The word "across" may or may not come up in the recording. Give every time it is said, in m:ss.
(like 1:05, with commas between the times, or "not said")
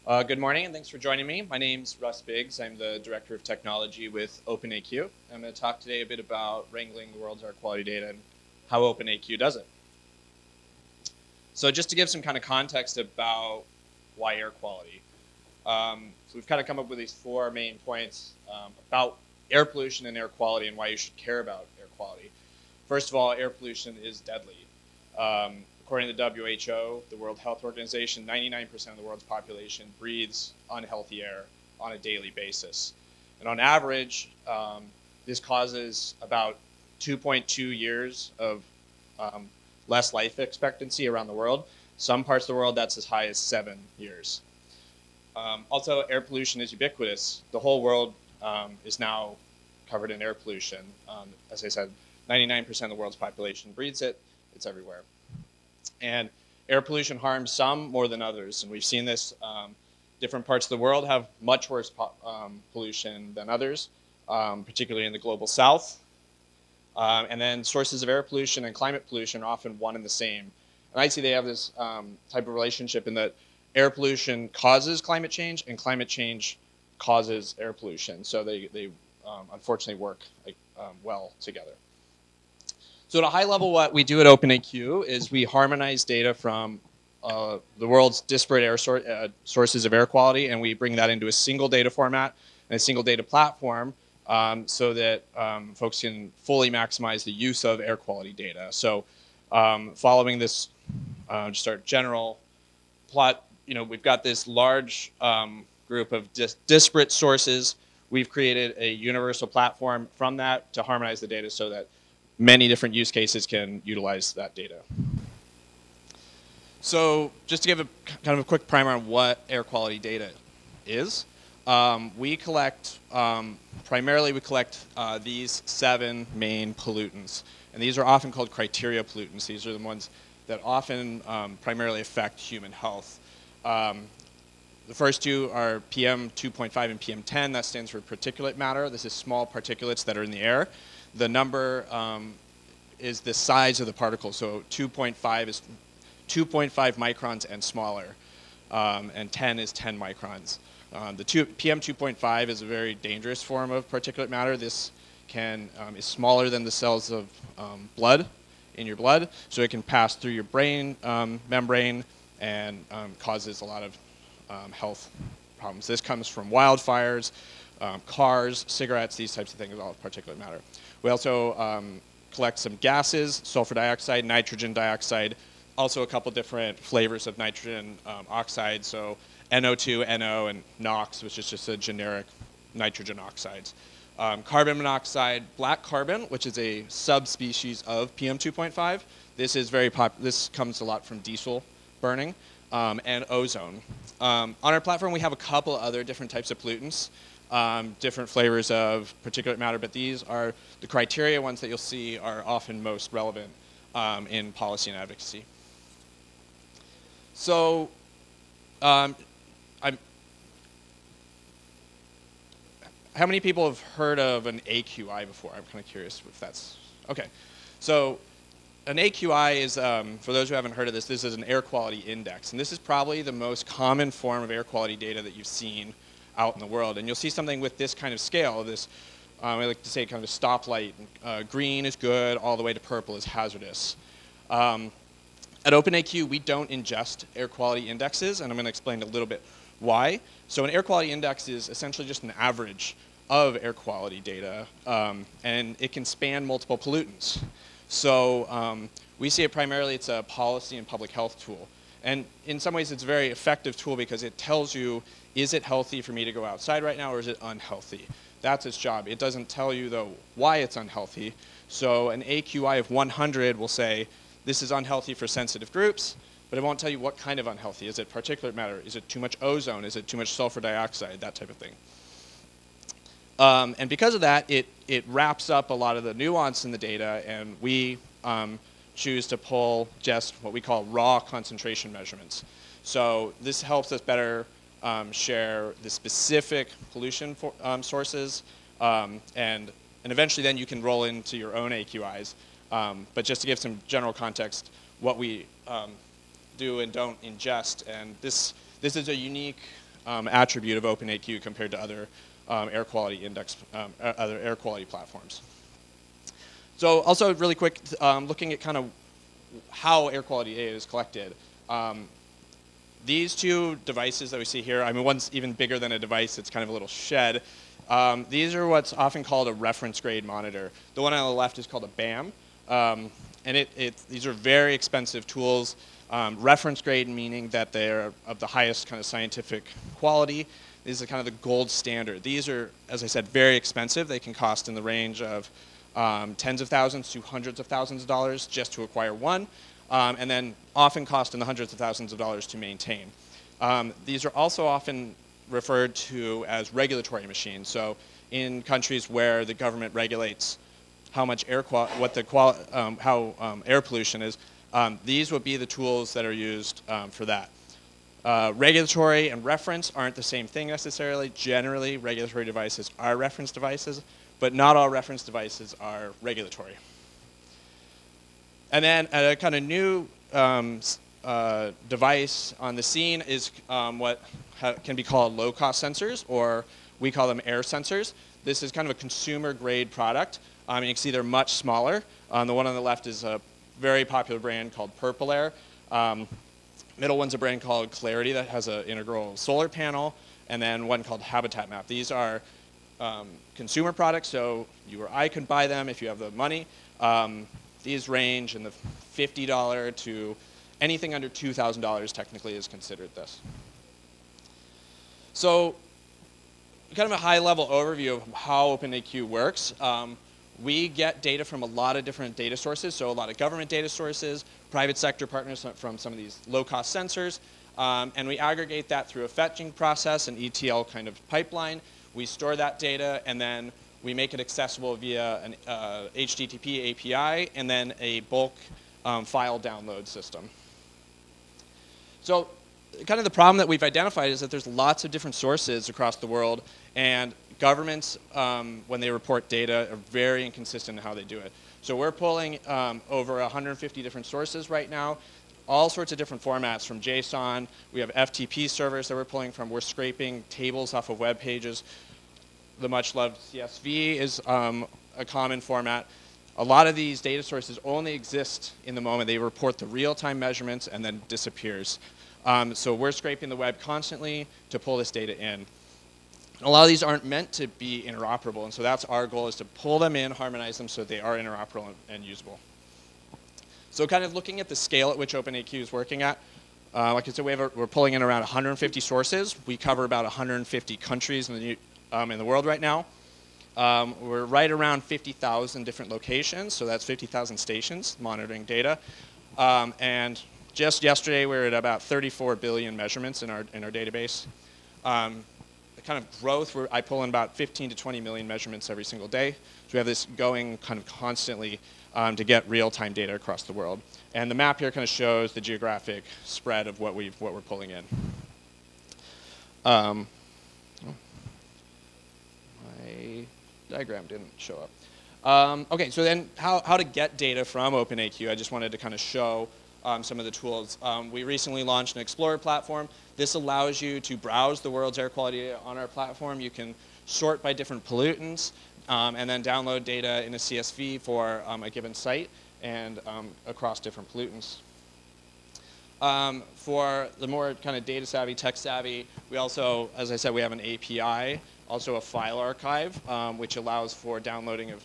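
7:15, 8:23, 8:53.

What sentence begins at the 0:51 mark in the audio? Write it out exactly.
Um, as I said, 99% of the world's population breathes it.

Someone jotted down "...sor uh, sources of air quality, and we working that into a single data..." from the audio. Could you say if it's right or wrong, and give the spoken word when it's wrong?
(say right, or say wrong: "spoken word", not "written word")
wrong: "bring", not "working".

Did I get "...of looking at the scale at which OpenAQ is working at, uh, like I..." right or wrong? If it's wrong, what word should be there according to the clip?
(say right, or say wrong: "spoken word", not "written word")
right.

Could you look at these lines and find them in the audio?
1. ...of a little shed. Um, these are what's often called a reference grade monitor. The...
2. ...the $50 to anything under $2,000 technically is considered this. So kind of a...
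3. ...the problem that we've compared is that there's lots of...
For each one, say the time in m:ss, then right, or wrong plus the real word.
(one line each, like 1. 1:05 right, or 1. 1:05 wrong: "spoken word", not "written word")
1. 5:16 right
2. 6:38 right
3. 7:13 wrong: "identified", not "compared".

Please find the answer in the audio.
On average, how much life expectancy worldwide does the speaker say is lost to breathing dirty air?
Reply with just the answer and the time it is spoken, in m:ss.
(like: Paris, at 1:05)
2.2 years, at 0:36.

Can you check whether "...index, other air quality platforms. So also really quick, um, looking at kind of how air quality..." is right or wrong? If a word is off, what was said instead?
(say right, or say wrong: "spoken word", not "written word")
right.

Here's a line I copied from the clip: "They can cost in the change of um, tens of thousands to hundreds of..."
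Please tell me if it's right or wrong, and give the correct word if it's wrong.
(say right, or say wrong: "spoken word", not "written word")
wrong: "range", not "change".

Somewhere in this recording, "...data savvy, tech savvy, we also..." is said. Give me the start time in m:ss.
8:58.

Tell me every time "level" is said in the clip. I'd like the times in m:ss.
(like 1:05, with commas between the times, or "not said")
1:23, 6:47.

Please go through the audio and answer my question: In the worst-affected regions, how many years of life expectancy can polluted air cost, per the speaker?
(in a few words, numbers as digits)
7 years.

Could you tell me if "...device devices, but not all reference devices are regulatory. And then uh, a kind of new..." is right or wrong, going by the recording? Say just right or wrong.
wrong.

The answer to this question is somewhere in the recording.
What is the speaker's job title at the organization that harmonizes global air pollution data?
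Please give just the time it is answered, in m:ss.
0:03.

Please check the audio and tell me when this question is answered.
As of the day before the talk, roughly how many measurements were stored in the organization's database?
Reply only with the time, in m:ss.
8:12.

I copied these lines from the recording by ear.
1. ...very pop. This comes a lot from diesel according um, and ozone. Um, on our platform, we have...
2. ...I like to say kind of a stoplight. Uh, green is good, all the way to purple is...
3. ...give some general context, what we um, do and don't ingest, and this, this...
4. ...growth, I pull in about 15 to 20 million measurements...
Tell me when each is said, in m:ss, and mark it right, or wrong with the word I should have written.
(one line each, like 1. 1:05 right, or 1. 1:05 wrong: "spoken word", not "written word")
1. 3:09 wrong: "burning", not "according"
2. 3:49 right
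3. 4:53 right
4. 8:16 right.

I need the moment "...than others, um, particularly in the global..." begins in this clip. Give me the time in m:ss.
1:03.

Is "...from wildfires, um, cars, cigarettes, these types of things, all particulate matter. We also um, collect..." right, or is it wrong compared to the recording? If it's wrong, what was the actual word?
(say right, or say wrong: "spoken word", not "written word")
right.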